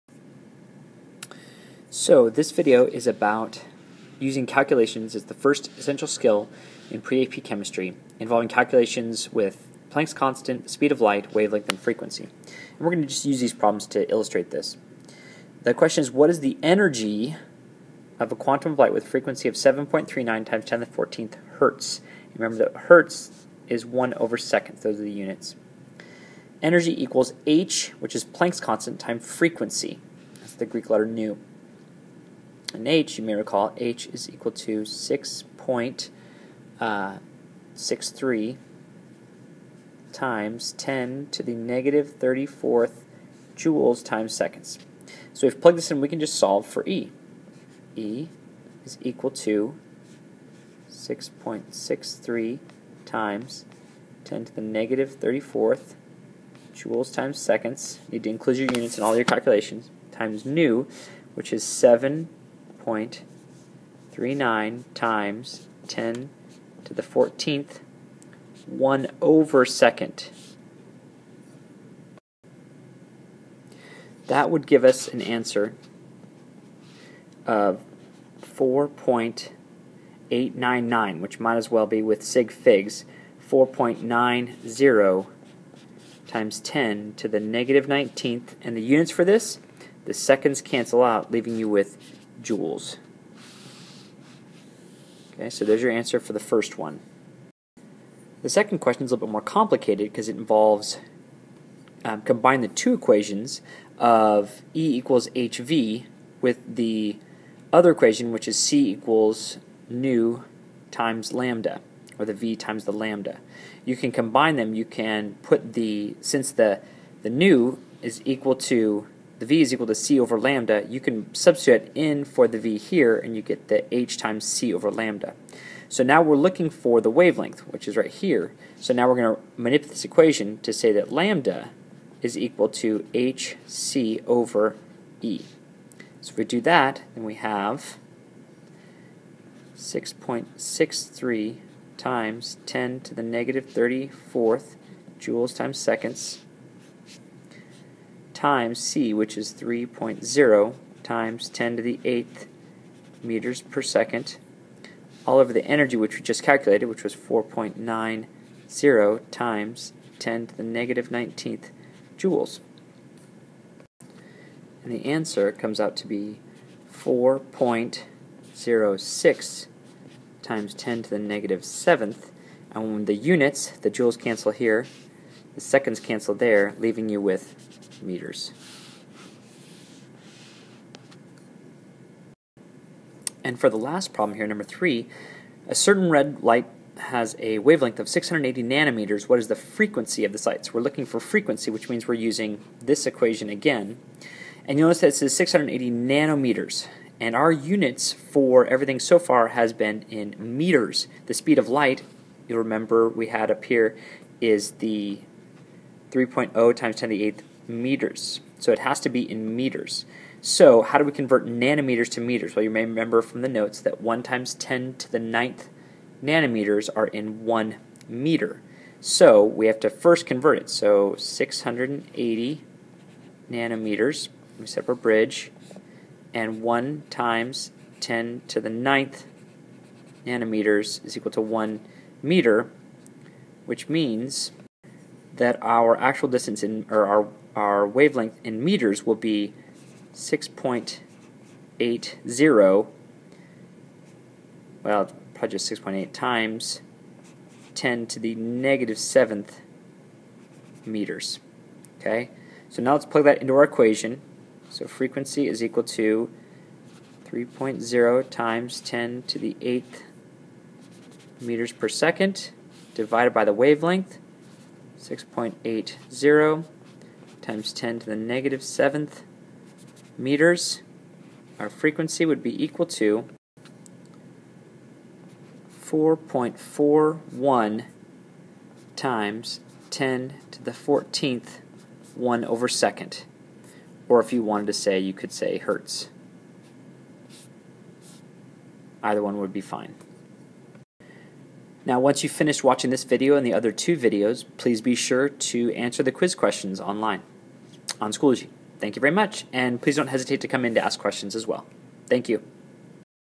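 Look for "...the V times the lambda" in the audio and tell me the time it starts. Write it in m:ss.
1:52.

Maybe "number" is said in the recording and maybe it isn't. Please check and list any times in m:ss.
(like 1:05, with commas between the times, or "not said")
3:04.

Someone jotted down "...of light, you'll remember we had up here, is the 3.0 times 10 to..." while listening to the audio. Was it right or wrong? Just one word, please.
right.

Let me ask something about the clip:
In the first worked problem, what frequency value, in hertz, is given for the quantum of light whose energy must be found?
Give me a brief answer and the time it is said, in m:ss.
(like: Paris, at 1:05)
7.39 x 10^14, at 0:19.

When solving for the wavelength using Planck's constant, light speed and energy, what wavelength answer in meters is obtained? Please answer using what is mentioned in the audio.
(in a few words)
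4.06 x 10^-7.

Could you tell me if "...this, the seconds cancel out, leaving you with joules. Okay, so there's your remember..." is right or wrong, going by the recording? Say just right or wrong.
wrong.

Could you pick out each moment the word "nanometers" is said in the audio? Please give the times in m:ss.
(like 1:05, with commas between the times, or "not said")
3:08, 3:15, 3:31, 3:36, 3:43, 3:50.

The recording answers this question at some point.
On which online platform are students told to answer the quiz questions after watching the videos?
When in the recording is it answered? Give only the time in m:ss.
4:58.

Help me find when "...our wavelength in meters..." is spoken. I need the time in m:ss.
3:57.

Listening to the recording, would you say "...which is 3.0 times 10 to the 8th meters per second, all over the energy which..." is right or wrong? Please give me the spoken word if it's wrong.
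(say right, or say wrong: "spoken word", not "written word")
right.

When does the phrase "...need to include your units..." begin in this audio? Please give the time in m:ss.
0:58.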